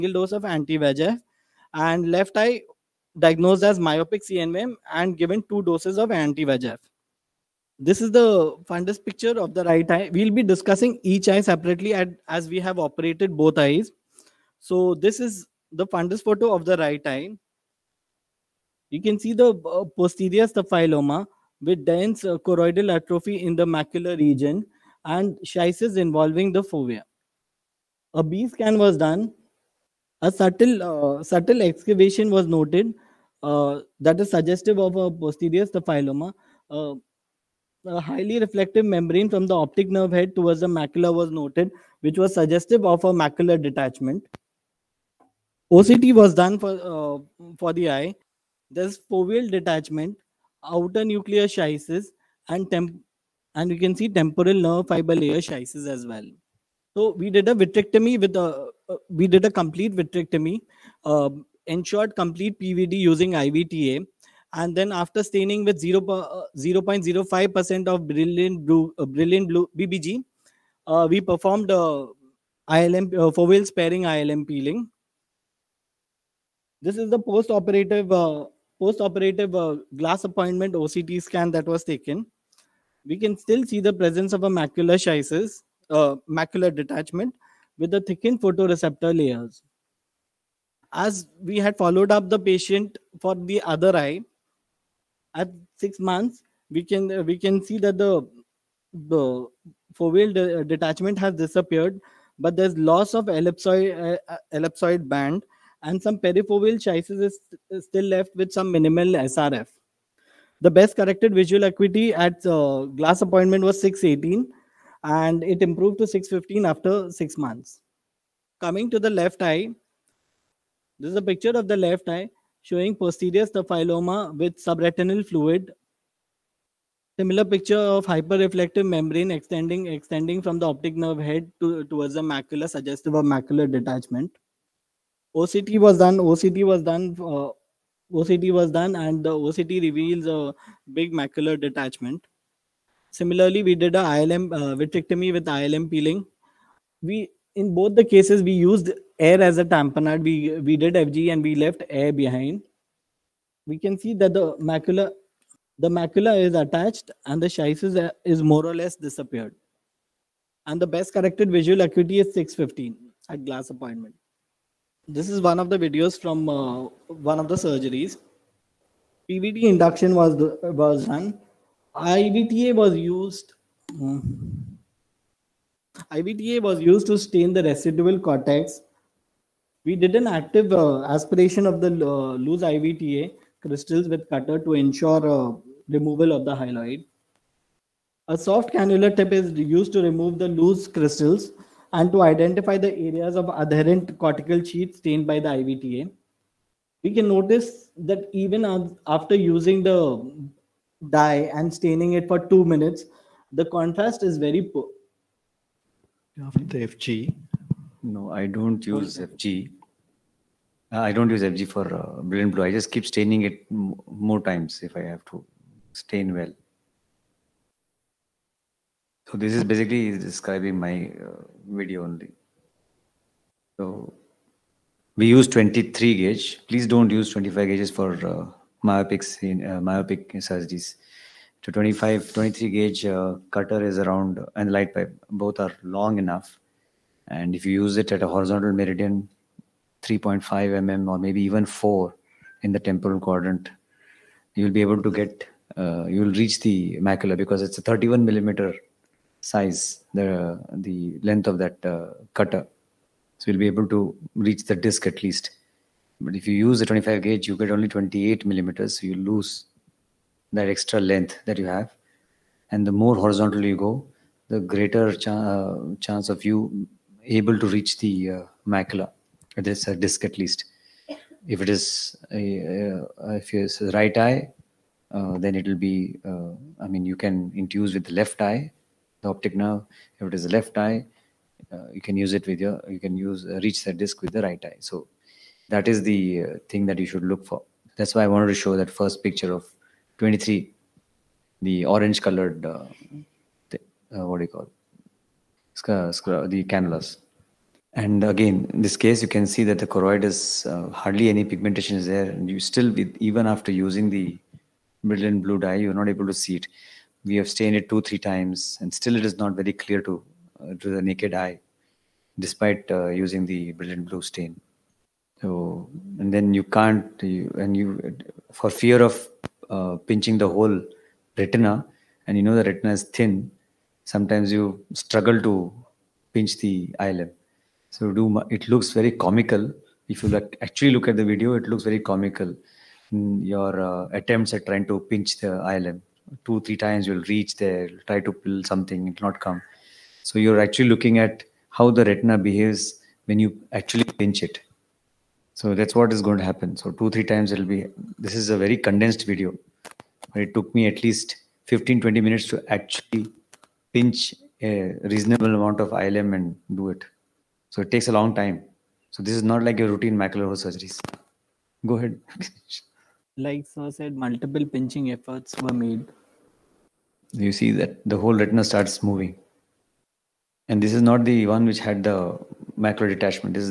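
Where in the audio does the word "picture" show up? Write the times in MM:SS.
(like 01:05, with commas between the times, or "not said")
00:09, 02:01, 02:07, 04:49.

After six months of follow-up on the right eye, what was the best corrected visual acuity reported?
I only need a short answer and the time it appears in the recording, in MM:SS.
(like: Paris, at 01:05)
6/15, at 01:56.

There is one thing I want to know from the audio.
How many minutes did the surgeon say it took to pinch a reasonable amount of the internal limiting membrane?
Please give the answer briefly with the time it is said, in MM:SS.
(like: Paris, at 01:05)
15 to 20 minutes, at 05:51.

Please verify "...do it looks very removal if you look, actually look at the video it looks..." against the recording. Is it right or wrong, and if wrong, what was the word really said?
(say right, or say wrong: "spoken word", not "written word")
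wrong: "comical", not "removal".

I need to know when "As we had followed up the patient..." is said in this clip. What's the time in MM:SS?
01:30.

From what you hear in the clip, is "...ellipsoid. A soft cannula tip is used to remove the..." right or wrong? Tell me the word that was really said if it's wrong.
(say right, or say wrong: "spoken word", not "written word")
wrong: "hyaloid", not "ellipsoid".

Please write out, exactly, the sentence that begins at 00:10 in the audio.
We'll be discussing each eye separately at, as we have operated both eyes.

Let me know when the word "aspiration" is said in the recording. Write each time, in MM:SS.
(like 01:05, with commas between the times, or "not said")
03:01.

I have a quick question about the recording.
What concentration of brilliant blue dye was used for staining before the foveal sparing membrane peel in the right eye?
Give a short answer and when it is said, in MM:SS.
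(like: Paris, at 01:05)
0.05 percent, at 01:06.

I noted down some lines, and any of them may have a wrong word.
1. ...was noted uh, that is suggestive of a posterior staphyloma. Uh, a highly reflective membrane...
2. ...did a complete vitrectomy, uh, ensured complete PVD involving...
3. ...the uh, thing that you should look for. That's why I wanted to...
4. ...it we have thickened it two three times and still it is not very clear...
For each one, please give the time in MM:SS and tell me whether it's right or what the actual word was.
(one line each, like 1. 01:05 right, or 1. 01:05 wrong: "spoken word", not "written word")
1. 00:32 right
2. 00:59 wrong: "using", not "involving"
3. 04:46 right
4. 05:06 wrong: "stained", not "thickened".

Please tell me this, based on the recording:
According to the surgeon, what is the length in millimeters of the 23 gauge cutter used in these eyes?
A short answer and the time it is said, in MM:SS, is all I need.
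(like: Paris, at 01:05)
31 millimeters, at 04:07.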